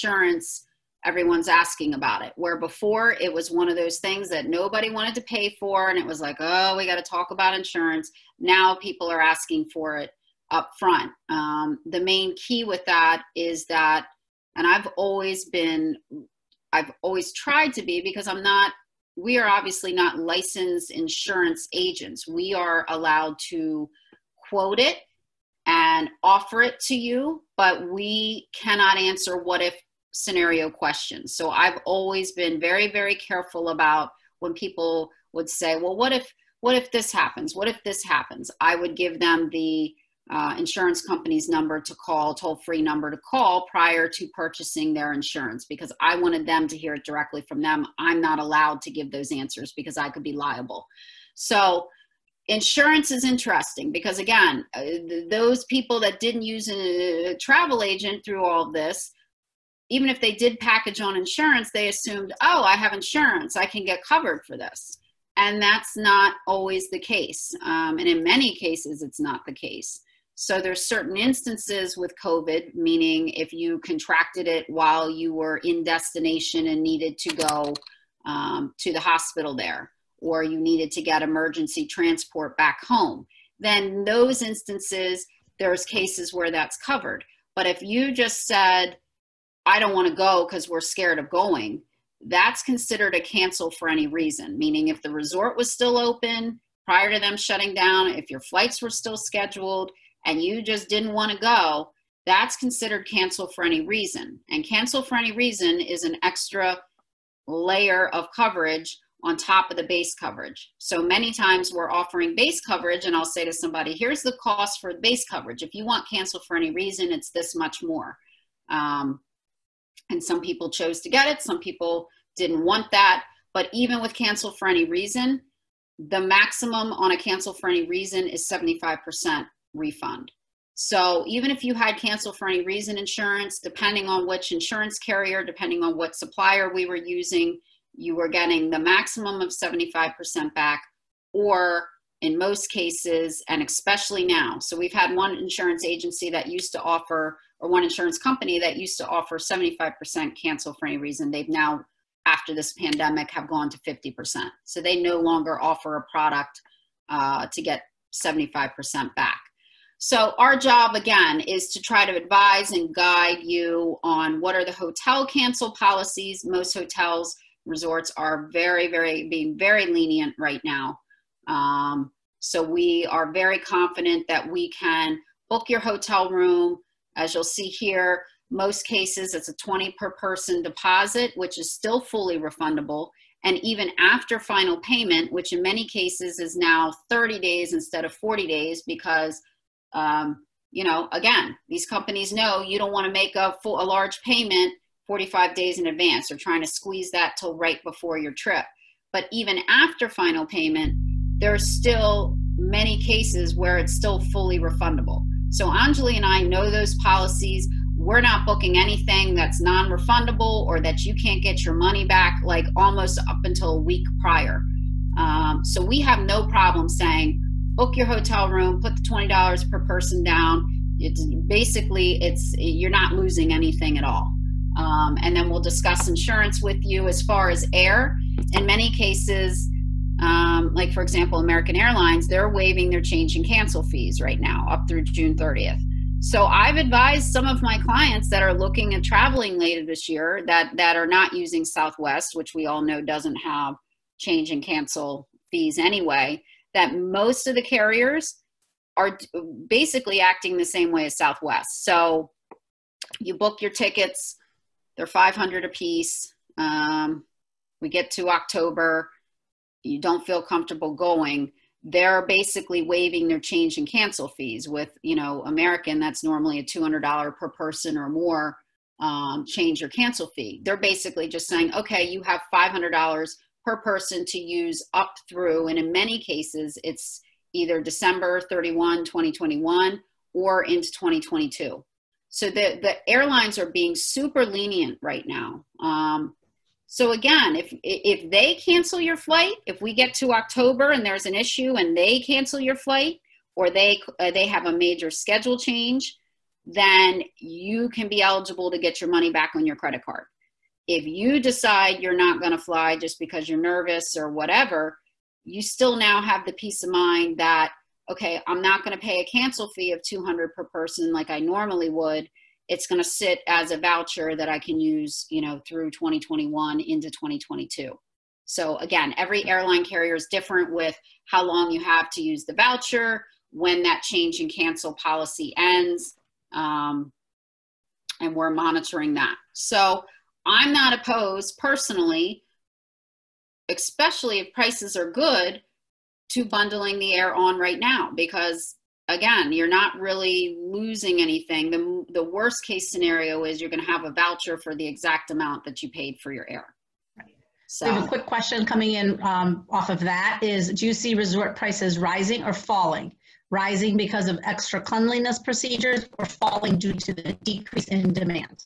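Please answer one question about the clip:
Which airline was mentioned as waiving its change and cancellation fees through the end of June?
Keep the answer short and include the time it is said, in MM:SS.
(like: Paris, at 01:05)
American Airlines, at 03:51.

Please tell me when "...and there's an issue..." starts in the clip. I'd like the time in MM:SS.
04:50.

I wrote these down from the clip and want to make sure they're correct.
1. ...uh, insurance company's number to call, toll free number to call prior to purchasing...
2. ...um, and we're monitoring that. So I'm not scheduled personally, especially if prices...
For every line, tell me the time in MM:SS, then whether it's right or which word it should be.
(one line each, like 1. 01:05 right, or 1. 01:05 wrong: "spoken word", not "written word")
1. 00:40 right
2. 05:26 wrong: "opposed", not "scheduled".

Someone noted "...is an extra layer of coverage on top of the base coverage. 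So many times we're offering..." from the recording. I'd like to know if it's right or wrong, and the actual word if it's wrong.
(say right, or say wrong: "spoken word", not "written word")
right.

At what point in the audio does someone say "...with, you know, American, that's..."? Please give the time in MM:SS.
04:24.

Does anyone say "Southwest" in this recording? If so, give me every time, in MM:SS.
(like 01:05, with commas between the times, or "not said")
04:01, 04:11.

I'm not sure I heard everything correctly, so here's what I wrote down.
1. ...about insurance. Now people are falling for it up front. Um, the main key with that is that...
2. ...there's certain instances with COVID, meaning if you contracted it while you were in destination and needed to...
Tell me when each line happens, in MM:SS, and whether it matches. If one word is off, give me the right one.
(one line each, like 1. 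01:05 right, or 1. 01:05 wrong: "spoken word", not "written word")
1. 00:07 wrong: "asking", not "falling"
2. 01:10 right.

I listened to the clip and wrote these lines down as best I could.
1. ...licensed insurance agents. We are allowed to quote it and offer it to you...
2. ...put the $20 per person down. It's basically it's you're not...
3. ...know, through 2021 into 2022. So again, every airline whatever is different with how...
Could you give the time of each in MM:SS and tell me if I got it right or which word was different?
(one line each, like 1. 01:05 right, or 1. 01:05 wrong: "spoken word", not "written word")
1. 00:20 right
2. 03:38 right
3. 05:15 wrong: "carrier", not "whatever".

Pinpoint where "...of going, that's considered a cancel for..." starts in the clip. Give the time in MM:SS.
01:31.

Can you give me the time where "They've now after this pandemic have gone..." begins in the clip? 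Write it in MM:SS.
02:31.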